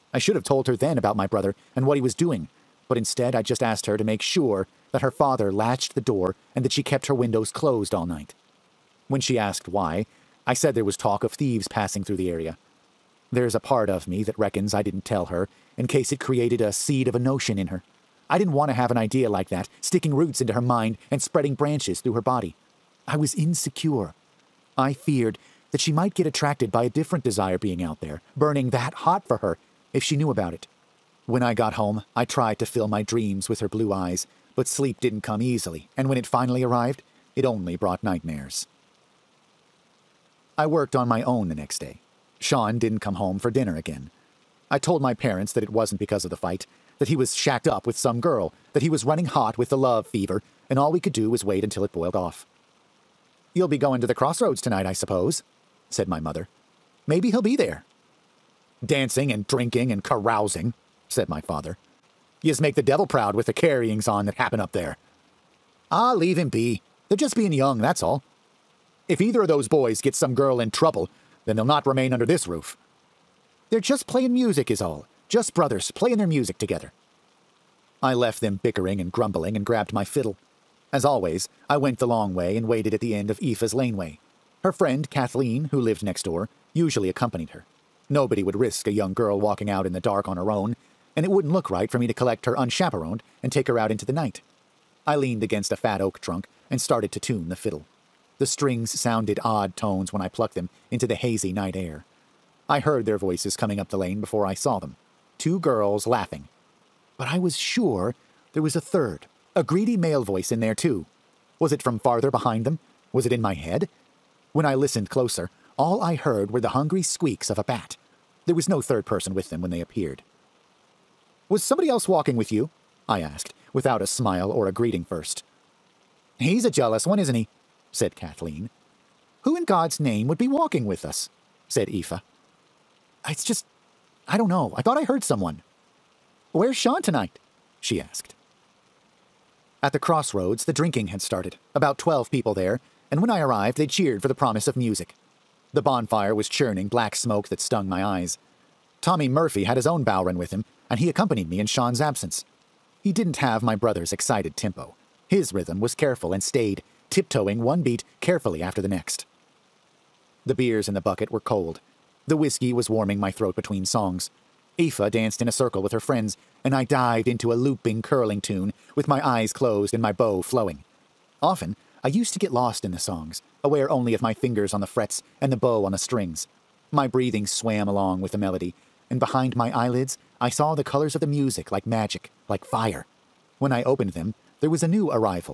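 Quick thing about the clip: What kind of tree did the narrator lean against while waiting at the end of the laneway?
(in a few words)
Oak.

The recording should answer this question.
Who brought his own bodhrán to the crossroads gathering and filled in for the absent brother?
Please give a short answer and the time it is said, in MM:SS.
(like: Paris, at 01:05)
Tommy Murphy, at 02:29.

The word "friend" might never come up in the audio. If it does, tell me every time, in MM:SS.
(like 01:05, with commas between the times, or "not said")
01:24, 02:45.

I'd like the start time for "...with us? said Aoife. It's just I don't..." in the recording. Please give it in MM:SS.
02:10.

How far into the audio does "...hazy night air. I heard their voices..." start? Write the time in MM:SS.
01:41.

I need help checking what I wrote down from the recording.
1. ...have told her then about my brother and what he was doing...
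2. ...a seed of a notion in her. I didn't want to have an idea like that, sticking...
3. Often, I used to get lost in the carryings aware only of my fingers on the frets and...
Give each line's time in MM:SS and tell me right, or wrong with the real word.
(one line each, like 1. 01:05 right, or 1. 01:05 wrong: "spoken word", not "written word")
1. 00:00 right
2. 00:16 right
3. 02:51 wrong: "songs", not "carryings".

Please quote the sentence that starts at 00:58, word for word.
Dancing and drinking and carousing, said my father.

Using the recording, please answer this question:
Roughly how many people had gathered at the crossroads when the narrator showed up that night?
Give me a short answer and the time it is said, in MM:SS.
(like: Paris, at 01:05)
12, at 02:21.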